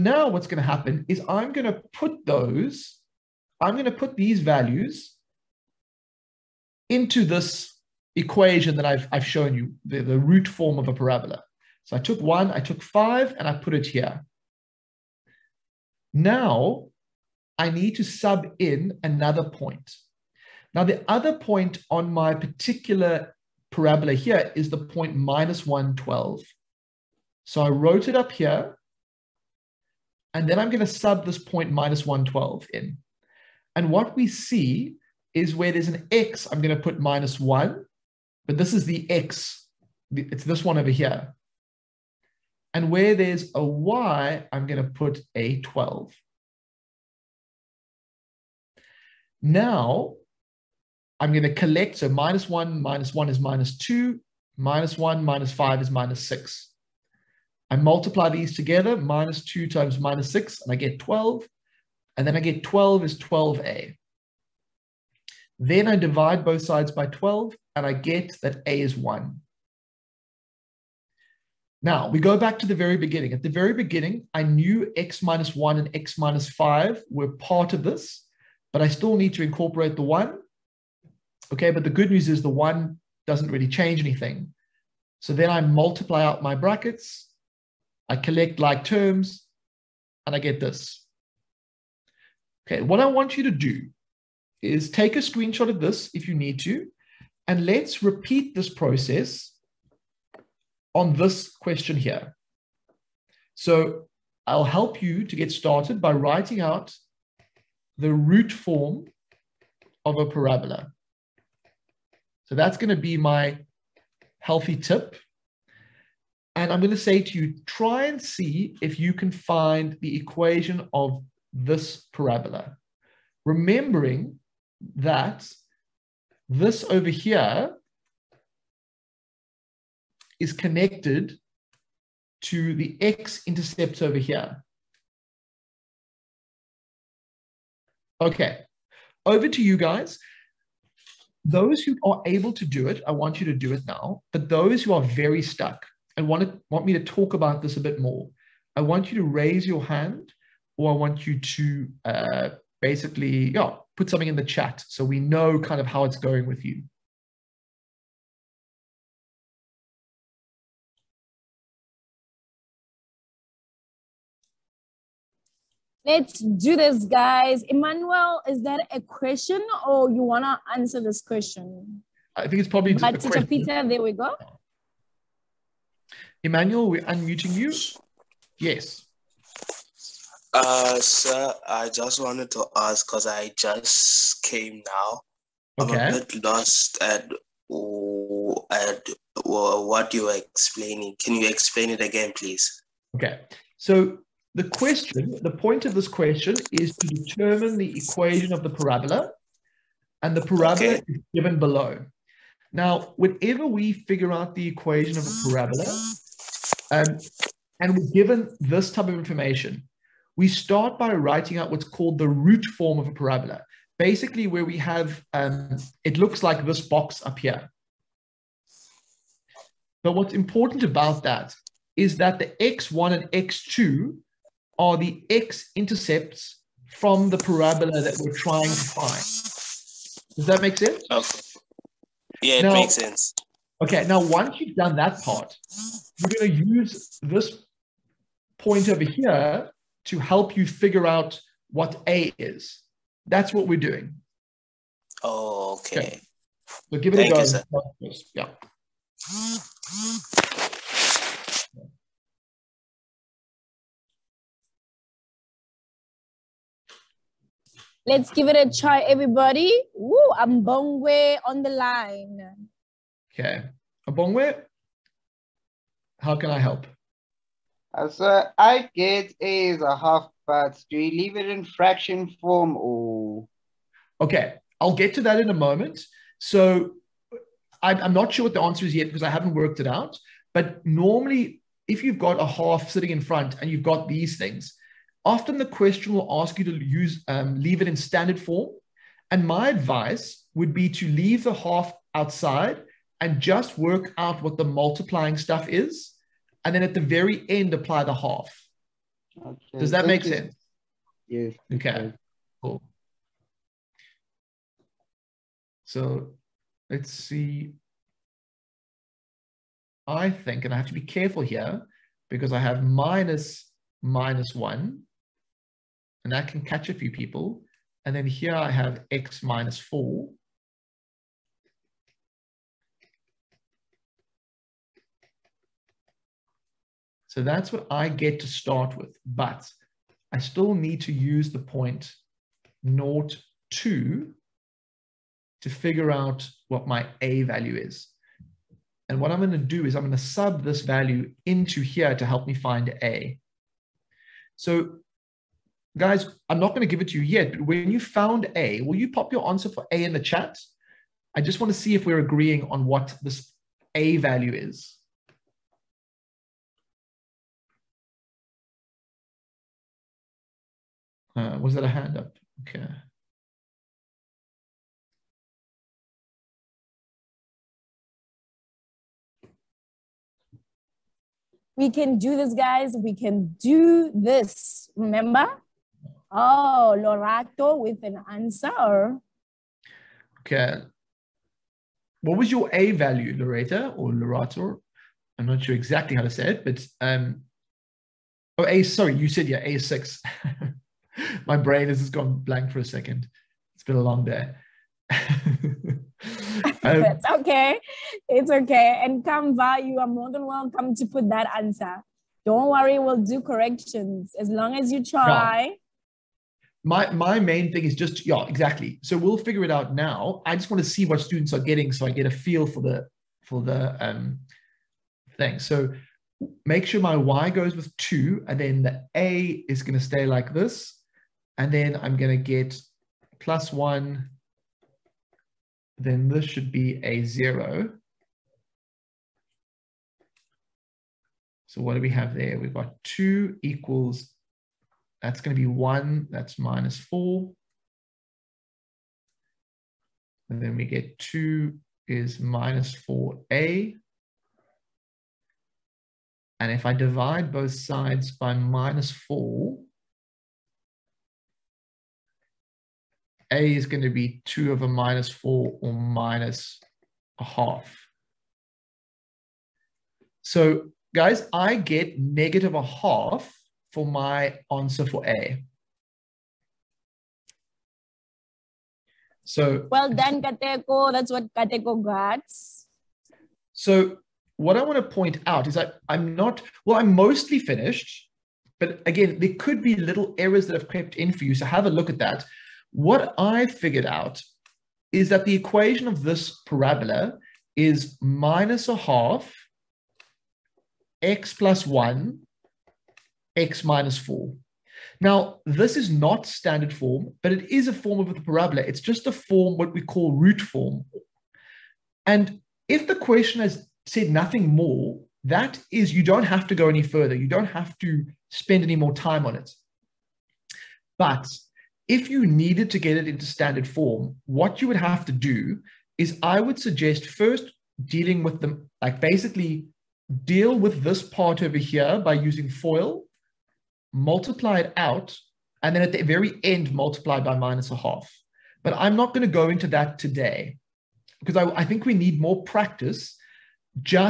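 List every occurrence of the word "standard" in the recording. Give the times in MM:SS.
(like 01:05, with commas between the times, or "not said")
04:47, 08:16, 08:33.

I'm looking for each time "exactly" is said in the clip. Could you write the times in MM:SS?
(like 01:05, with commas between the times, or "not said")
06:25, 06:48.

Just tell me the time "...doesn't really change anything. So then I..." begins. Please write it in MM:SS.
01:23.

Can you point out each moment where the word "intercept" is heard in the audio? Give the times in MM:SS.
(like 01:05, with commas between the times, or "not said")
02:13, 03:45.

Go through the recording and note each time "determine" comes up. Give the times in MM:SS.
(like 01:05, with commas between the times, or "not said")
03:17.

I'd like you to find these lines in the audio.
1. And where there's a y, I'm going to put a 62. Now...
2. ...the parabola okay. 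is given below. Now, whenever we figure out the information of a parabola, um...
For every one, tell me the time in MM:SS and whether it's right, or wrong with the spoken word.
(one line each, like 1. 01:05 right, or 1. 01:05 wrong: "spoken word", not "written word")
1. 00:42 wrong: "12", not "62"
2. 03:20 wrong: "equation", not "information".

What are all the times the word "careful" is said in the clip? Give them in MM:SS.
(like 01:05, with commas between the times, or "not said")
05:11.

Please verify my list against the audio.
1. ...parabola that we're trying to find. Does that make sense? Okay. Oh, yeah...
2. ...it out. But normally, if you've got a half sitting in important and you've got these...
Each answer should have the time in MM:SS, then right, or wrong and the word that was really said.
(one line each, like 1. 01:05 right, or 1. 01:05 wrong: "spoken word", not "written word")
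1. 03:47 right
2. 04:39 wrong: "front", not "important".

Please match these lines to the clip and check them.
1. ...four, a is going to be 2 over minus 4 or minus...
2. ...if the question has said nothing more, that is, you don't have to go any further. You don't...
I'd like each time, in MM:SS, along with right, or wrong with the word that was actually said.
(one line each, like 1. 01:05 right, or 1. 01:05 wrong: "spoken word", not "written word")
1. 07:29 right
2. 08:22 right.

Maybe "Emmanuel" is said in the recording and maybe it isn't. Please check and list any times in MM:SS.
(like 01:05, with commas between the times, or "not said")
02:47, 02:56.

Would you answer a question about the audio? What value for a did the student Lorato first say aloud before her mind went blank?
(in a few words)
6.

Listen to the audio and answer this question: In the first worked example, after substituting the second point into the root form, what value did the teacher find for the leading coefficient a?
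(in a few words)
1.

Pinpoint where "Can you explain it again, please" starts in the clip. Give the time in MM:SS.
03:11.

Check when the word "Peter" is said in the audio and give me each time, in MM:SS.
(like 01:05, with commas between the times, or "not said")
02:53.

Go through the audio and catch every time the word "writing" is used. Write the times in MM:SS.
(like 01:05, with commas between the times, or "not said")
01:46, 03:31.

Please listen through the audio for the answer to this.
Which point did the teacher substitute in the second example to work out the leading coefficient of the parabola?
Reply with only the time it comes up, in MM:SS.
05:32.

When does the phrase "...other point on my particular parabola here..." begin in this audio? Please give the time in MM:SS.
00:21.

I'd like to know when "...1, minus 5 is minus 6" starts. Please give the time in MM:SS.
00:54.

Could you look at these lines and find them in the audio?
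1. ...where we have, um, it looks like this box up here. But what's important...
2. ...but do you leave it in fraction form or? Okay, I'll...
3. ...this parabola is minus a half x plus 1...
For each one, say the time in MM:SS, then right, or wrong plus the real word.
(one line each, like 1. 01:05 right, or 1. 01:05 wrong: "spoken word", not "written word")
1. 03:34 right
2. 04:30 right
3. 08:06 right.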